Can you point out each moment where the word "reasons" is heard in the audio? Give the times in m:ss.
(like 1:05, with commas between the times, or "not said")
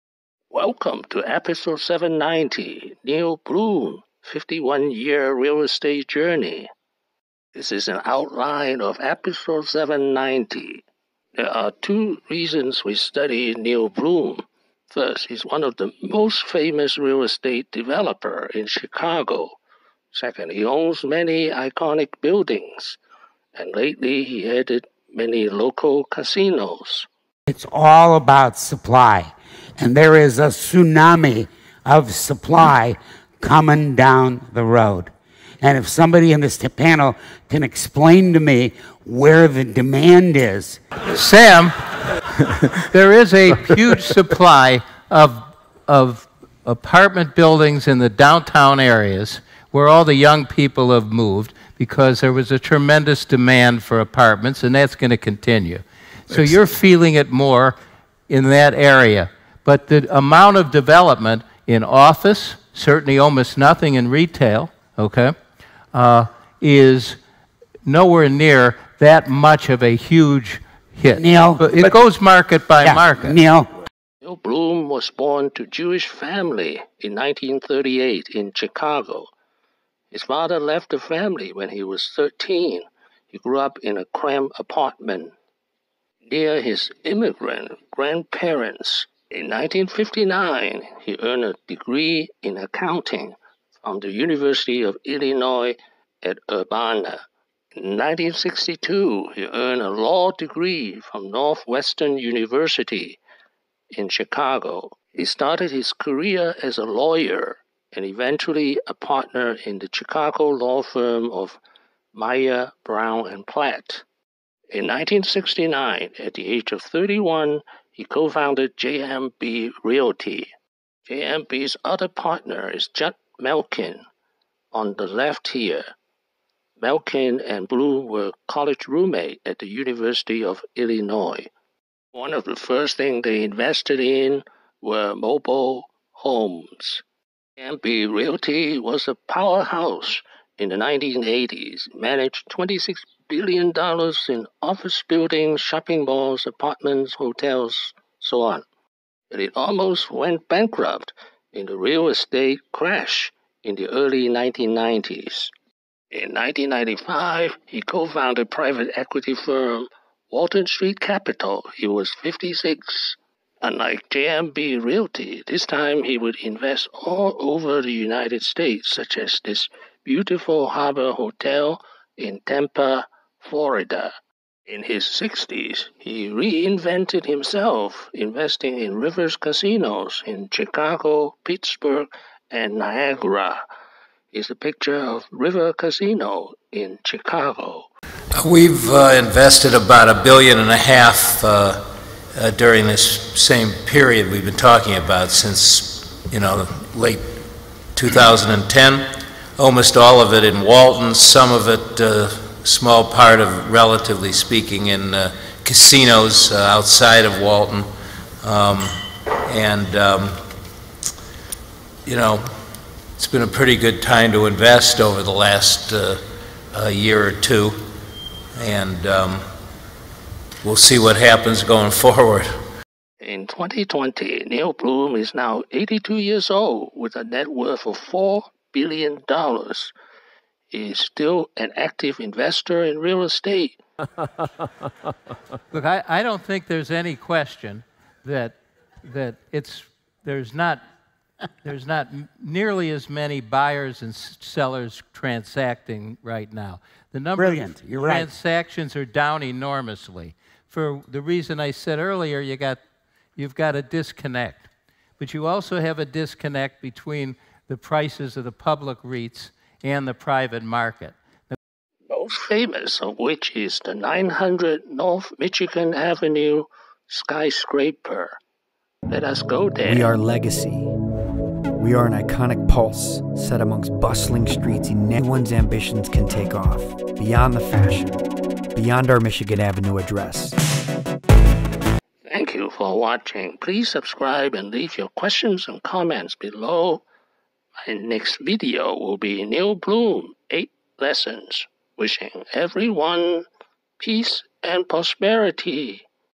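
0:12, 4:11.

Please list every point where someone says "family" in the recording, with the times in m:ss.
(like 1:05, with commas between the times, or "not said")
1:16, 1:20.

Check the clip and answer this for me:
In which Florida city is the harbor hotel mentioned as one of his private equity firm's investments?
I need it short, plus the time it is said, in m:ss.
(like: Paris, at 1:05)
Tampa, at 2:52.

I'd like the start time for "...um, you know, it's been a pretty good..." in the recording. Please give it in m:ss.
3:29.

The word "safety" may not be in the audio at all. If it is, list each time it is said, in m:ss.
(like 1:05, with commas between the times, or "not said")
not said.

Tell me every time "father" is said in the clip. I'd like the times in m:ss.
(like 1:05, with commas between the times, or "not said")
1:20.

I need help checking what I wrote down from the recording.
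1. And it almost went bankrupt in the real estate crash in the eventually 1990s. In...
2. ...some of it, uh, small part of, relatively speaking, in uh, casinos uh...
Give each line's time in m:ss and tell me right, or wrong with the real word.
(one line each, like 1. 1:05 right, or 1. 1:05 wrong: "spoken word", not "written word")
1. 2:29 wrong: "early", not "eventually"
2. 3:21 right.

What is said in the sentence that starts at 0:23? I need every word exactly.
And lately, he headed many local casinos.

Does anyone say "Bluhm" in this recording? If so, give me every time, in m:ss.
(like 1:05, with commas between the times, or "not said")
0:03, 0:13, 1:14, 2:07, 3:44, 4:49.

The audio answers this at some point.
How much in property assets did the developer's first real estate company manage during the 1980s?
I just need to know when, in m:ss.
2:22.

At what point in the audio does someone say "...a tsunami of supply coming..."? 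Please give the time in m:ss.
0:30.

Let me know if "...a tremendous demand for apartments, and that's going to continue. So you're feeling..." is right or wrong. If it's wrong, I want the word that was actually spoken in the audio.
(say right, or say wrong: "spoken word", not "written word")
right.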